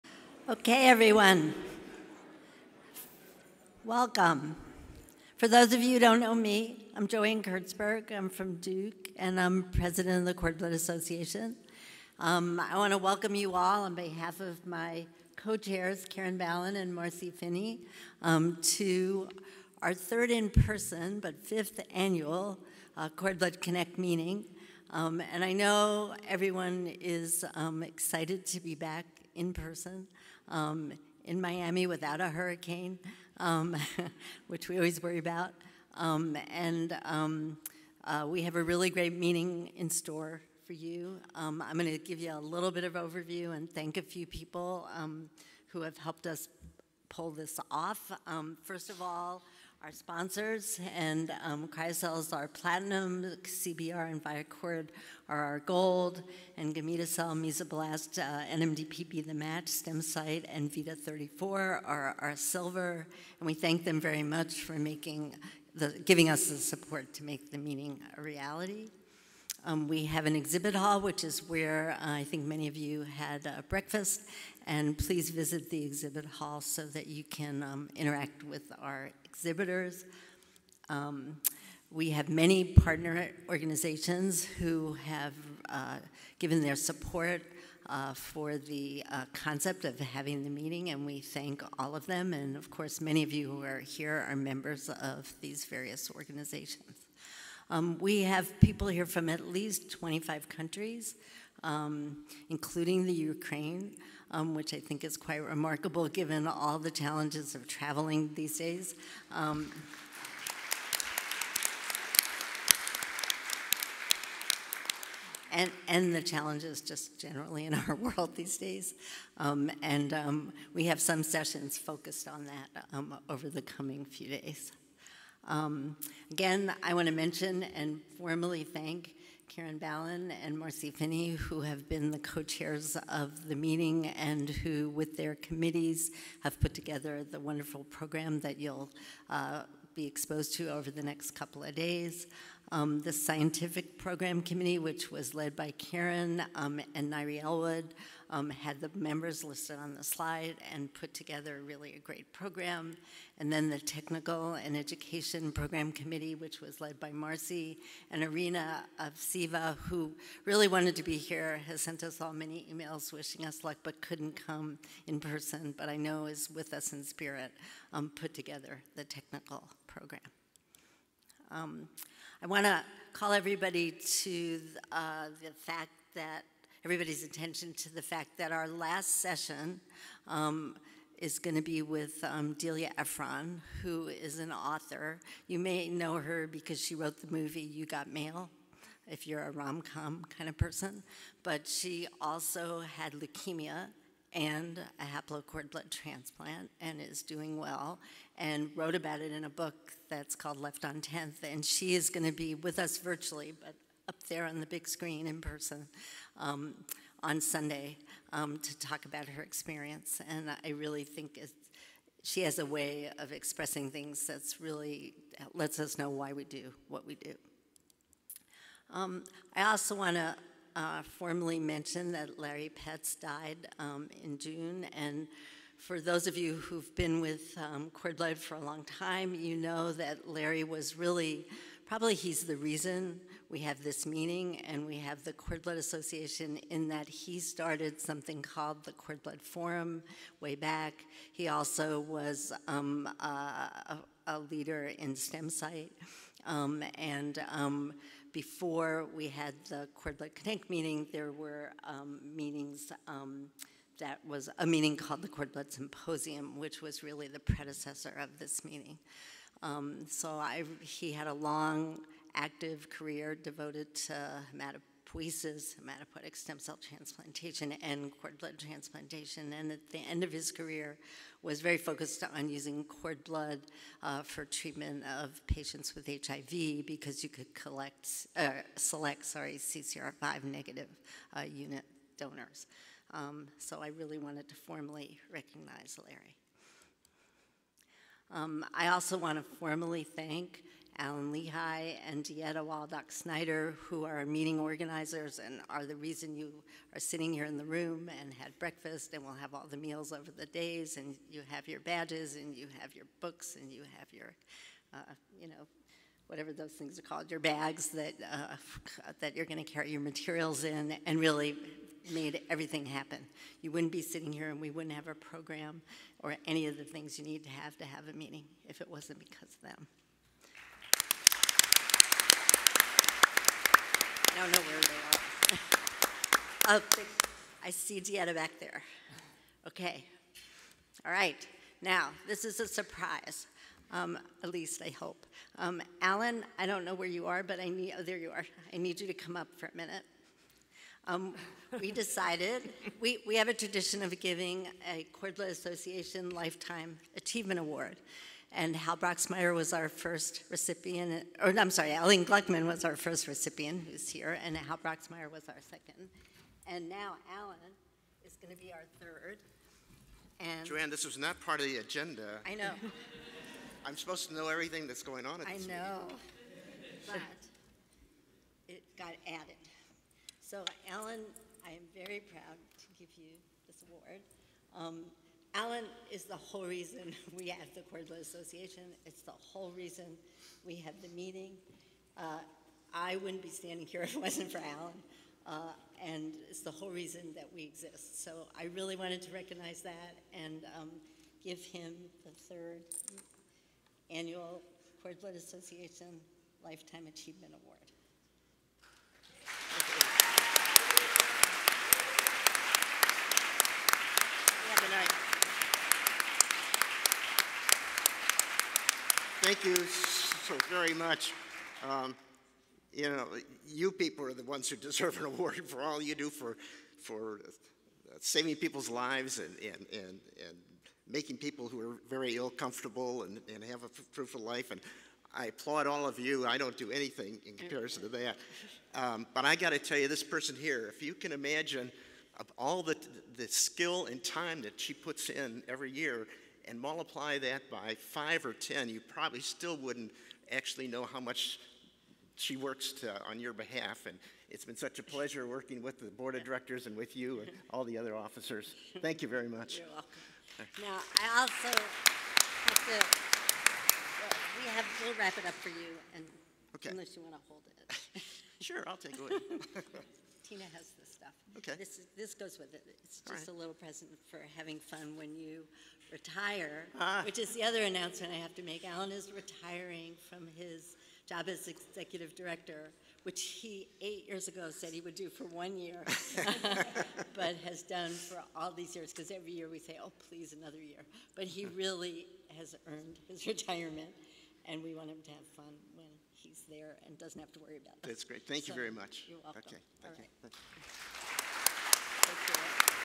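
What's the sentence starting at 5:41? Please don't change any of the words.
Um, we decided, we, we have a tradition of giving a Cord Blood Association Lifetime Achievement Award.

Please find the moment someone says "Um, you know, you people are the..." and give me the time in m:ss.
6:51.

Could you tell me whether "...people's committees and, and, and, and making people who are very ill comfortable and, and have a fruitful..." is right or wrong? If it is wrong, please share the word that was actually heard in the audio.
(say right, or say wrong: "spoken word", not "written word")
wrong: "lives", not "committees".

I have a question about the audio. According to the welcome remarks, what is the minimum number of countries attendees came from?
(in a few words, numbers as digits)
25.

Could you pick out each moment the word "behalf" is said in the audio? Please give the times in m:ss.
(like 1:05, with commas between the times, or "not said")
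0:13, 7:23.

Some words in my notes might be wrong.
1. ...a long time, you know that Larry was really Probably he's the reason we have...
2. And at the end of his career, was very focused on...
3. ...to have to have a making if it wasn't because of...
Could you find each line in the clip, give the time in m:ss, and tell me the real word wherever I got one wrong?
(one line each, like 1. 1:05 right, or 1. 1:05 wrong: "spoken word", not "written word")
1. 3:48 right
2. 4:29 right
3. 5:17 wrong: "meeting", not "making".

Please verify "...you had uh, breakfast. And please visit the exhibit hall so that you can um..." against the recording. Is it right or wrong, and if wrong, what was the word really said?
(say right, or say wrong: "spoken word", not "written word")
right.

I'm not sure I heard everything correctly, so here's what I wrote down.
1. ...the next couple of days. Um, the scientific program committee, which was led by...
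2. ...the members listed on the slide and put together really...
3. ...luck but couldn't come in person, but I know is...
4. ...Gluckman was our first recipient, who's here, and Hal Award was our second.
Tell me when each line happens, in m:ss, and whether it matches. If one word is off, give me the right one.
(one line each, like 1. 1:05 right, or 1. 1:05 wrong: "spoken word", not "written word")
1. 2:20 right
2. 2:28 right
3. 2:43 right
4. 5:52 wrong: "Broxmeyer", not "Award".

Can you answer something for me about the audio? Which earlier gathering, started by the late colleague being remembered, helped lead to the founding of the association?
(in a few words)
Cord Blood Forum.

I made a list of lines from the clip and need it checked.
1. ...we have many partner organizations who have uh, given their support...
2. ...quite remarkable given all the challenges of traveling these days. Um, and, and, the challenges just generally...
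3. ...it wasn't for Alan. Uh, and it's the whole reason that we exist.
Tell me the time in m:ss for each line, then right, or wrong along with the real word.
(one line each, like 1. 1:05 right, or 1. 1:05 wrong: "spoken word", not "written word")
1. 1:21 right
2. 1:45 right
3. 6:24 right.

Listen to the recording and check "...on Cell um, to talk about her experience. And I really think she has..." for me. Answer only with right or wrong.
wrong.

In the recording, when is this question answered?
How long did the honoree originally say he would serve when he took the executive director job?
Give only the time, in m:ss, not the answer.
7:55.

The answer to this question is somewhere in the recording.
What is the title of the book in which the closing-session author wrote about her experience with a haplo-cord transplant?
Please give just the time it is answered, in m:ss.
3:20.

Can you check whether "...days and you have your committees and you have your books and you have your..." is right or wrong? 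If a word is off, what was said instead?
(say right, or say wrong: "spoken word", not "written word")
wrong: "badges", not "committees".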